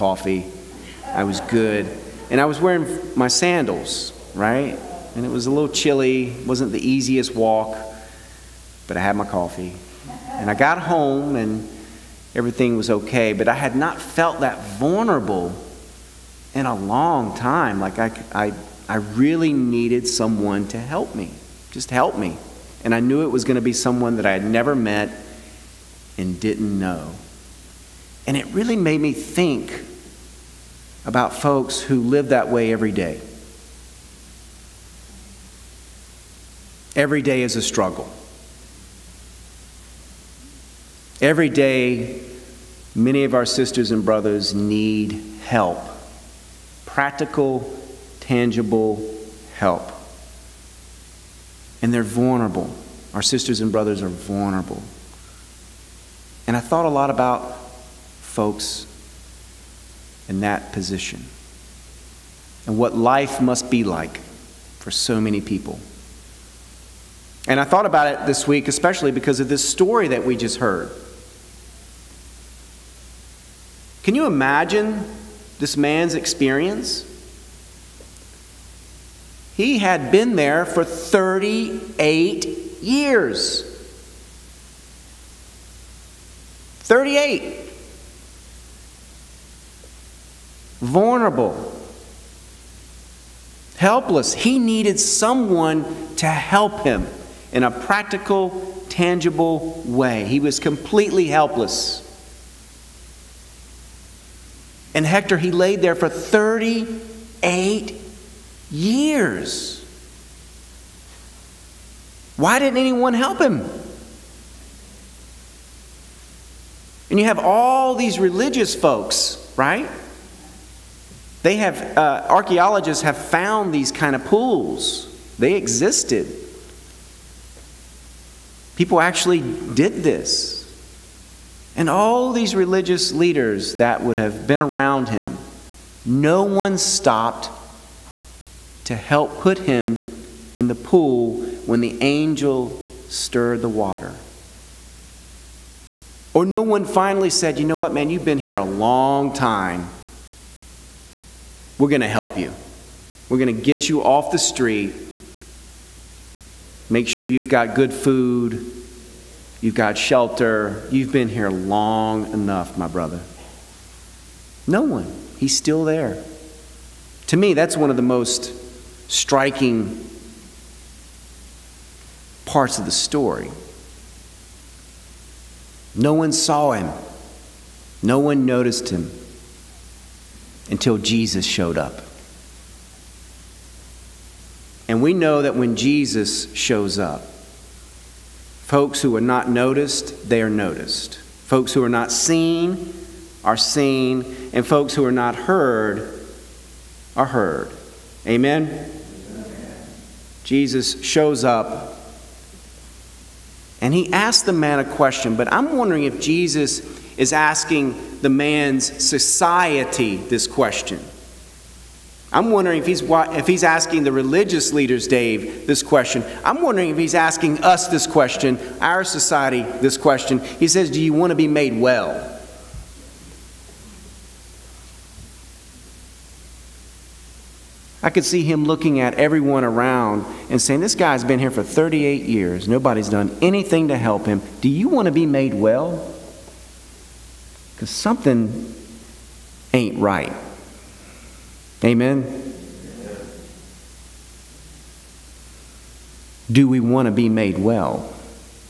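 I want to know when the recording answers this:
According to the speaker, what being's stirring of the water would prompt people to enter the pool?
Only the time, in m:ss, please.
2:21.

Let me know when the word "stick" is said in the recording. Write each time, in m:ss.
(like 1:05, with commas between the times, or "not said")
not said.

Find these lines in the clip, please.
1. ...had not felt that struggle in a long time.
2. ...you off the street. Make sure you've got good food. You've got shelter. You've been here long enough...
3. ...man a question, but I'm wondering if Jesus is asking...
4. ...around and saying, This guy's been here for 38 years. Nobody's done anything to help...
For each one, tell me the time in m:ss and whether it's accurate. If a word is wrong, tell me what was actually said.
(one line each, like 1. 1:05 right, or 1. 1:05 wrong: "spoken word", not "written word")
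1. 0:13 wrong: "vulnerable", not "struggle"
2. 2:33 right
3. 3:24 right
4. 3:49 right.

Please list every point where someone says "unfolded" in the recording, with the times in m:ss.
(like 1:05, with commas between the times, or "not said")
not said.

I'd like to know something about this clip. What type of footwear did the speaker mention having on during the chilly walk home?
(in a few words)
Sandals.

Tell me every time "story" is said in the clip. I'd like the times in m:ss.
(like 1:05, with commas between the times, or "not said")
1:09, 2:52.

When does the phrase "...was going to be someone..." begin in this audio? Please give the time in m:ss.
0:23.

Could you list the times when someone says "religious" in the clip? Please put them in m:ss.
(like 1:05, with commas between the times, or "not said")
1:58, 2:12, 3:34.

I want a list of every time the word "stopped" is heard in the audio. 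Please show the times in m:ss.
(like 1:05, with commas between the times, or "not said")
2:16.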